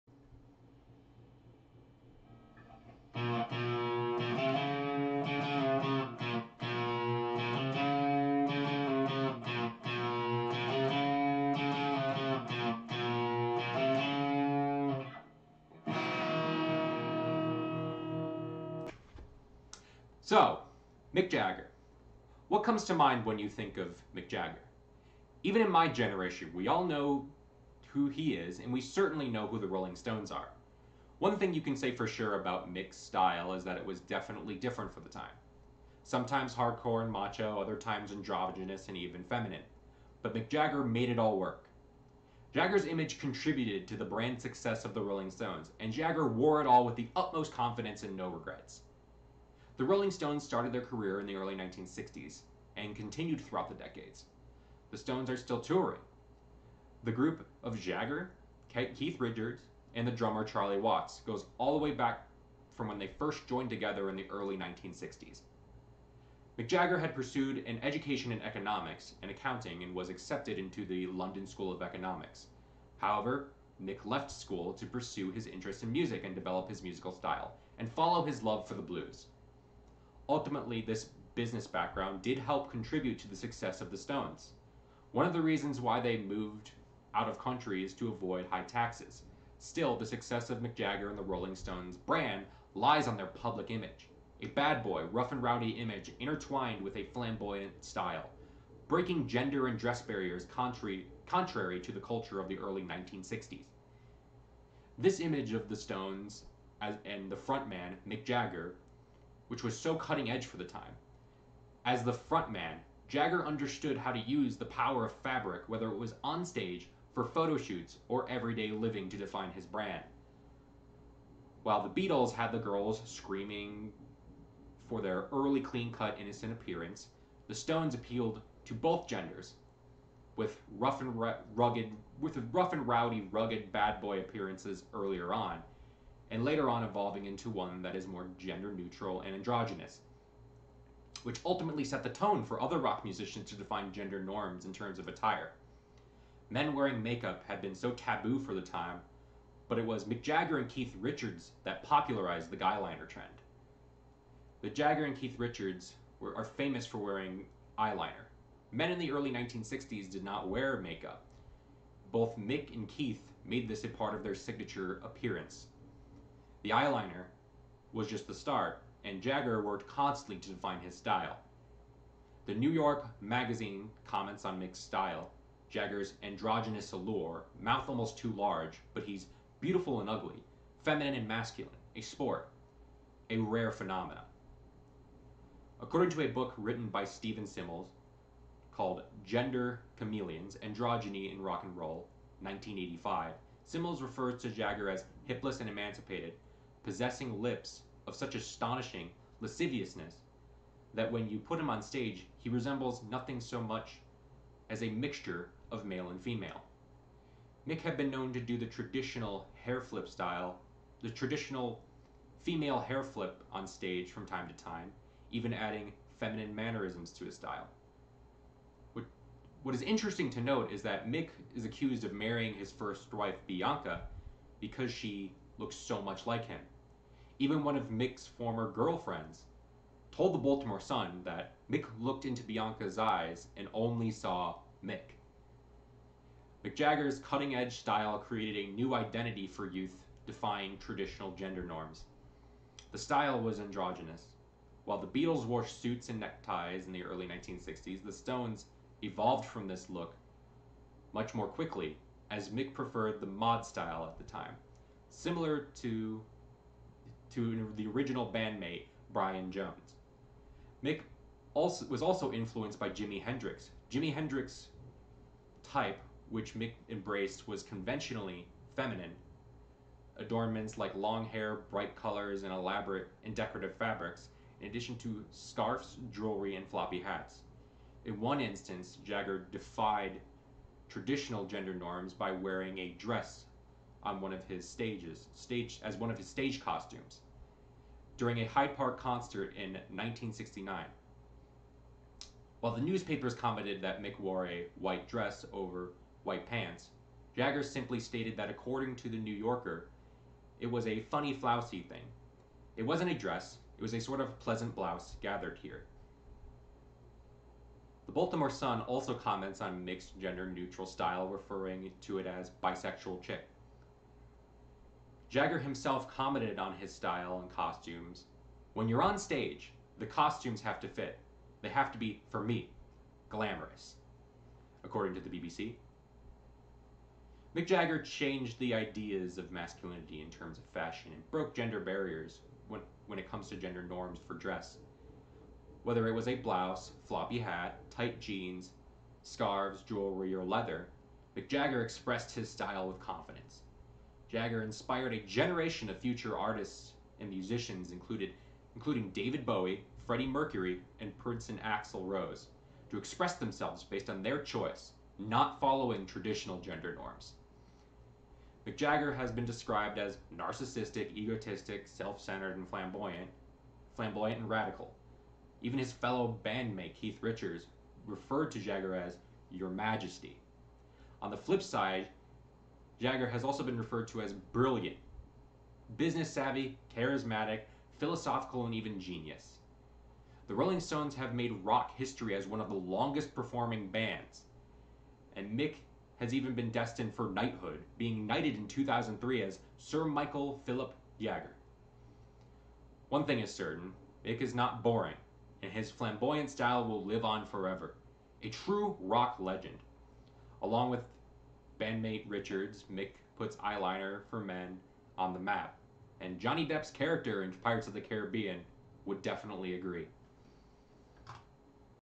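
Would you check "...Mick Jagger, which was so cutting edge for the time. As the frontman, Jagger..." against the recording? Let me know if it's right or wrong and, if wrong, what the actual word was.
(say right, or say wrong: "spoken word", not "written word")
right.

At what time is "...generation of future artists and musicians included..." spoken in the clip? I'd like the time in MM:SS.
05:45.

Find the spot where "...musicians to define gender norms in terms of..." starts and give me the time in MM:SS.
02:23.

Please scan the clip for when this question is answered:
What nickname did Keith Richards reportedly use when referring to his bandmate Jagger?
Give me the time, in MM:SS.
06:09.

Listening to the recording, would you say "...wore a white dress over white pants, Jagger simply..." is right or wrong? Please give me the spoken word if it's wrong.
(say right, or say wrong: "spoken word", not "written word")
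right.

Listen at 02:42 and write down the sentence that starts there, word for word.
Both Mick and Keith made this a part of their signature appearance.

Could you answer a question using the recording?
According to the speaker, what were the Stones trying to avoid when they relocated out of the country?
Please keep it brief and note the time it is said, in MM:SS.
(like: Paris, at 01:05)
High taxes, at 01:28.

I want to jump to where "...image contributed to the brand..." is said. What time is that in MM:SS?
00:42.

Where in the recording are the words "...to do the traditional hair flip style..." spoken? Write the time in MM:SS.
03:28.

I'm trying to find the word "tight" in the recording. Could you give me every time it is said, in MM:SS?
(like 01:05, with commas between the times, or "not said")
05:37.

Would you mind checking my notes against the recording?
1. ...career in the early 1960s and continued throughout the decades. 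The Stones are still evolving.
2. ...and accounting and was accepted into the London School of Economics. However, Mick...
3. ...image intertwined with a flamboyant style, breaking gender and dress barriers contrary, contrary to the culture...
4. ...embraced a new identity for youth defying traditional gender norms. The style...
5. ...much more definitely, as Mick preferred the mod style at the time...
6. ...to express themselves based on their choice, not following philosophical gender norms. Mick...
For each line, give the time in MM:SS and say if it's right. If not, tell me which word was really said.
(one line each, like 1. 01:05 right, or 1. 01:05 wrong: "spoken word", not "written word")
1. 00:50 wrong: "touring", not "evolving"
2. 01:09 right
3. 01:35 right
4. 03:58 wrong: "created", not "embraced"
5. 04:11 wrong: "quickly", not "definitely"
6. 05:52 wrong: "traditional", not "philosophical".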